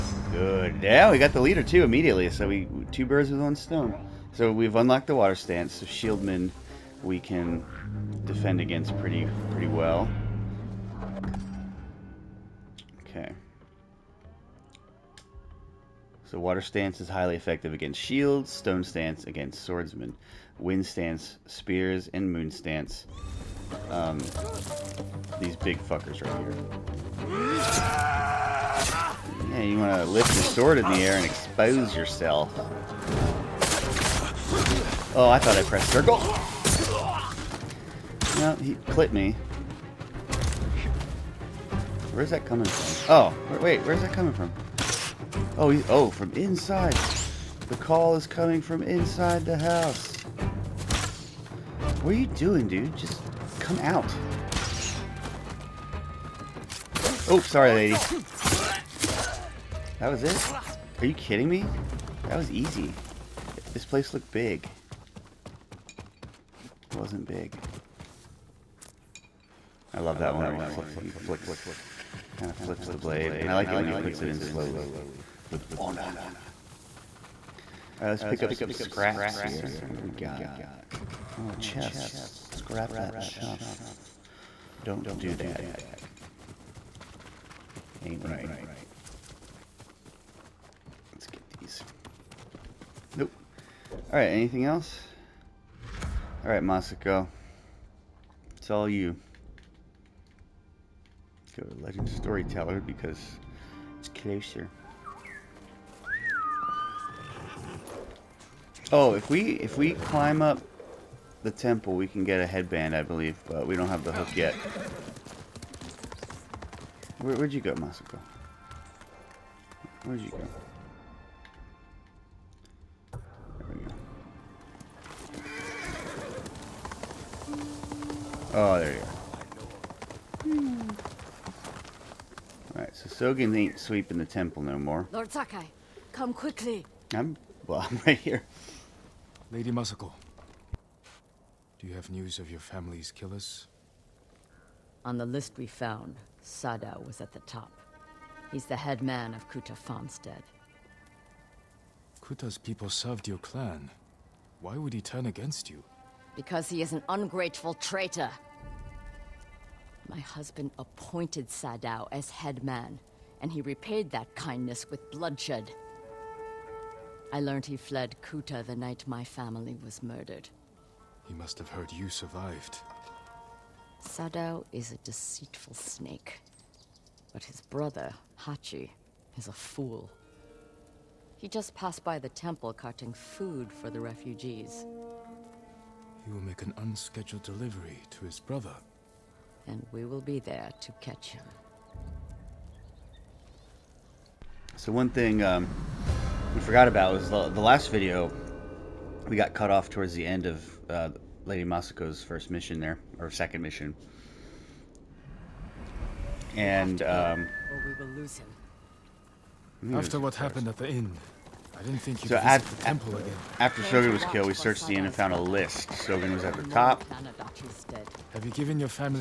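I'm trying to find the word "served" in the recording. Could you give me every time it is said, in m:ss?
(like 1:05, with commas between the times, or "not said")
2:32.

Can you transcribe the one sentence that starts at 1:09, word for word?
I love that one where he, fl he flicks Kind of flips the blade.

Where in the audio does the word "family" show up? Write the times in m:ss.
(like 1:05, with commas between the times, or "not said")
2:22, 2:49.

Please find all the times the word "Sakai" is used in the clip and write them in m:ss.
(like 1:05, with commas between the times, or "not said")
2:15.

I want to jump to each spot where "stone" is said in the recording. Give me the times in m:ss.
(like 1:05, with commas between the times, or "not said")
0:03, 0:18.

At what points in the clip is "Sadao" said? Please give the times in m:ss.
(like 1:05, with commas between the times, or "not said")
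2:26, 2:41, 2:54.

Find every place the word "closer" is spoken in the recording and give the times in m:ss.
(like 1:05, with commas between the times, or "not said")
1:44.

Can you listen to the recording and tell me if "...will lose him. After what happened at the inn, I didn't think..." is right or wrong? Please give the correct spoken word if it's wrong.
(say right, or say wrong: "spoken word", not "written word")
right.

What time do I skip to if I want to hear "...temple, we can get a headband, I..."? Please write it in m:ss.
1:51.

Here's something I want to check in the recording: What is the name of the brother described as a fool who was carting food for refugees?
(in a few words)
Hachi.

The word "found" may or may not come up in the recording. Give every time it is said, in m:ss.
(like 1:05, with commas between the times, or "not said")
2:25, 3:35.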